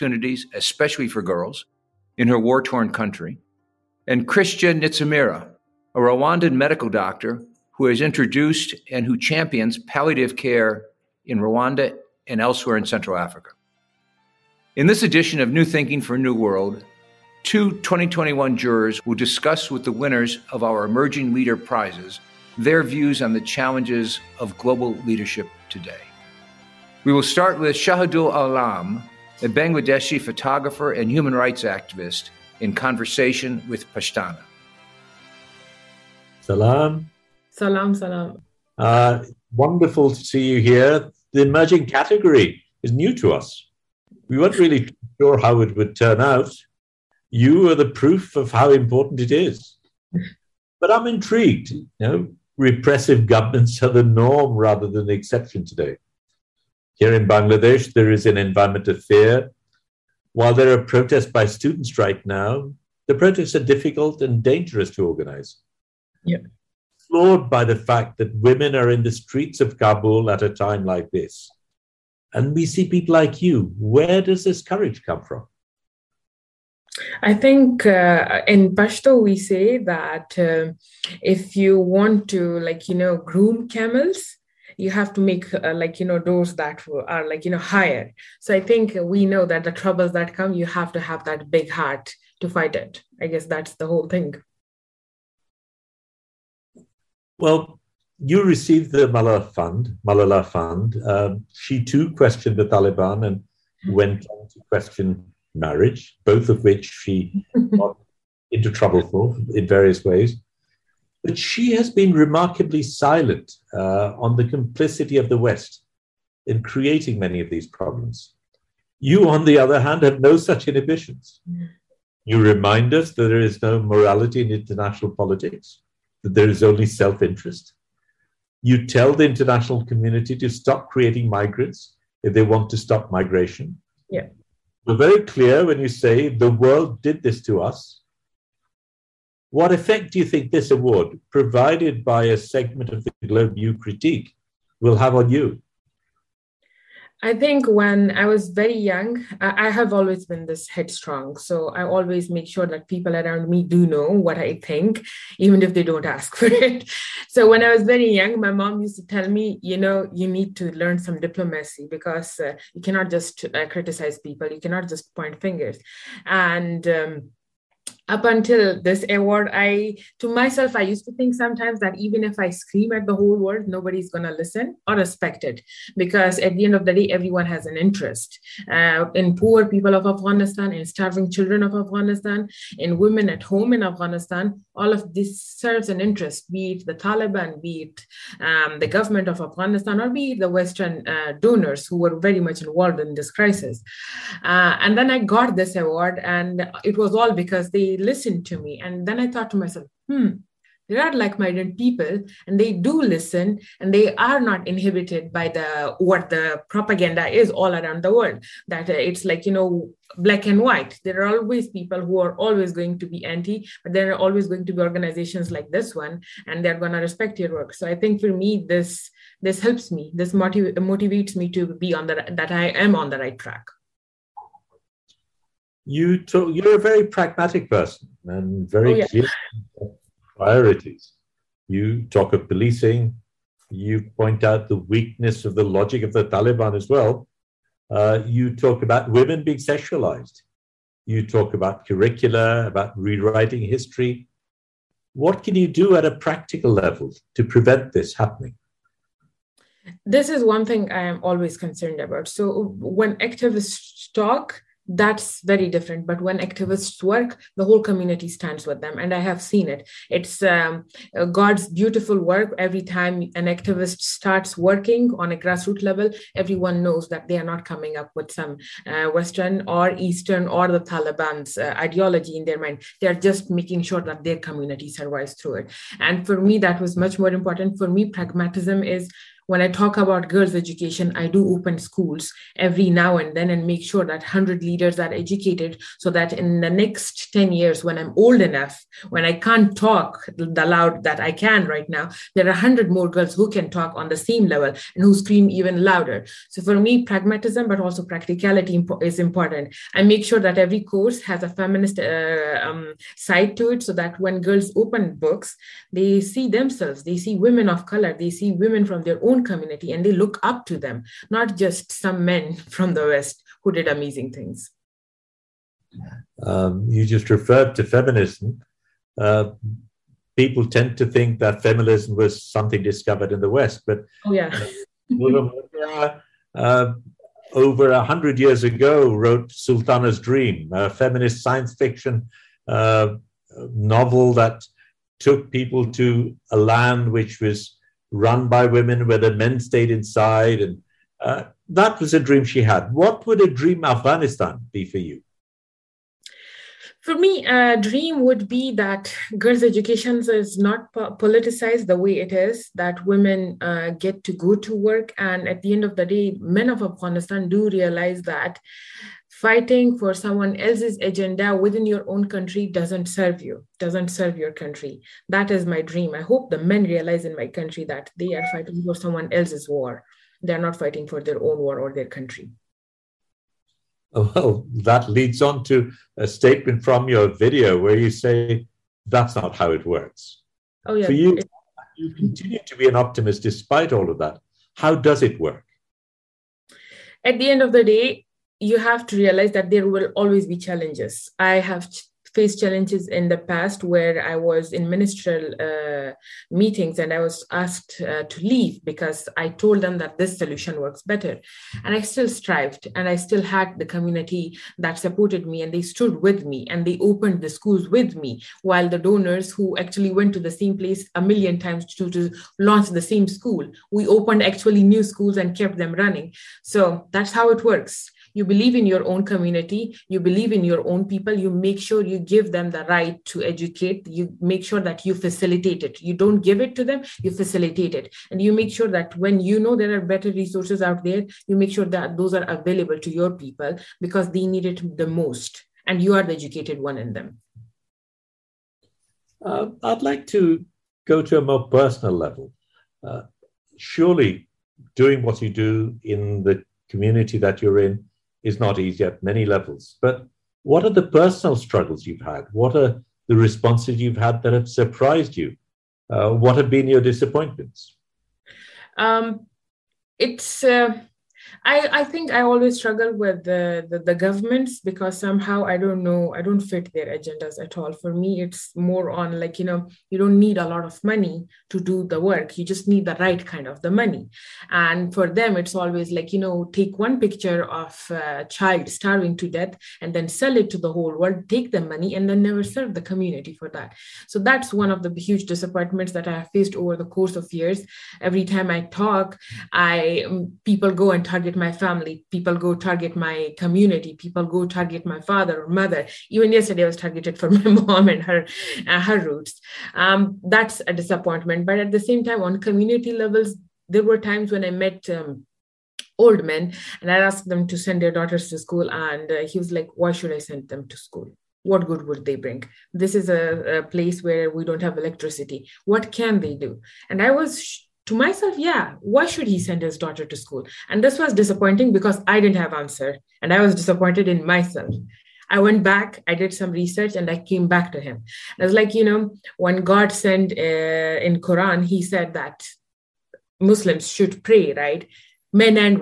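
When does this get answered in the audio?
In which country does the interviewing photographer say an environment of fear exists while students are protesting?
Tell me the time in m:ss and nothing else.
0:57.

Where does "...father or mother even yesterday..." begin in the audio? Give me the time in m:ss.
8:15.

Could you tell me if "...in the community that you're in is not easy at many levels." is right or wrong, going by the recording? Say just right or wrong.
right.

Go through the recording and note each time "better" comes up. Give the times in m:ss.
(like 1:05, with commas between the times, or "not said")
6:41, 7:10.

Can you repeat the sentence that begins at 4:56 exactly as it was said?
So for me, pragmatism, but also practicality is important.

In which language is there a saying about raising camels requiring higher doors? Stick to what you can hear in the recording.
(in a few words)
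Pashto.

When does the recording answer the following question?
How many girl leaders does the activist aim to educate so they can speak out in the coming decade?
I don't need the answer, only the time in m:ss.
4:44.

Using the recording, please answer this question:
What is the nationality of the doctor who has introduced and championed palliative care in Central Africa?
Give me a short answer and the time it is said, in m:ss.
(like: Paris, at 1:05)
Rwandan, at 0:05.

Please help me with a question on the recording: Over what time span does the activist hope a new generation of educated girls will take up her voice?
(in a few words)
10 years.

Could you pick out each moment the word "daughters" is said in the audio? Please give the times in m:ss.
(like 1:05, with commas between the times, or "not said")
8:28, 8:39.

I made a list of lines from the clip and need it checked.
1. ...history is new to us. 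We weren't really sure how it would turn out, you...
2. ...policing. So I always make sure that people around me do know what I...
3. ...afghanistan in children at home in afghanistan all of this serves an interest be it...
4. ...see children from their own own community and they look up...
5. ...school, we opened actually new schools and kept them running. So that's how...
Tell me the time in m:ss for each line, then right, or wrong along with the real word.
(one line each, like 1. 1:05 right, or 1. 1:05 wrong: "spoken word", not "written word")
1. 0:41 wrong: "category", not "history"
2. 2:30 wrong: "headstrong", not "policing"
3. 3:01 wrong: "women", not "children"
4. 5:08 wrong: "women", not "children"
5. 6:53 right.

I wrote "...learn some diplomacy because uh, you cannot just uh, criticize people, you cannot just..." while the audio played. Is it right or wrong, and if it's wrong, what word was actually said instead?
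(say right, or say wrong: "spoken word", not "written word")
right.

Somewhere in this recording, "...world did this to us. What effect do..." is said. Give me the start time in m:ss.
2:16.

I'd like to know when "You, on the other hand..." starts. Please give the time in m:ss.
1:58.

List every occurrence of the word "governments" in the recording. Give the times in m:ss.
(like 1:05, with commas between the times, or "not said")
0:53, 3:08, 7:44.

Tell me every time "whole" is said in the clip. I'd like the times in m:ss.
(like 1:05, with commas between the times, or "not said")
1:33, 2:53, 4:17, 8:00.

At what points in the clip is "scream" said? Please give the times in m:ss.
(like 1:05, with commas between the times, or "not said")
2:52, 4:55.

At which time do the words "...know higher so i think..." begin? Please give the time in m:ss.
1:27.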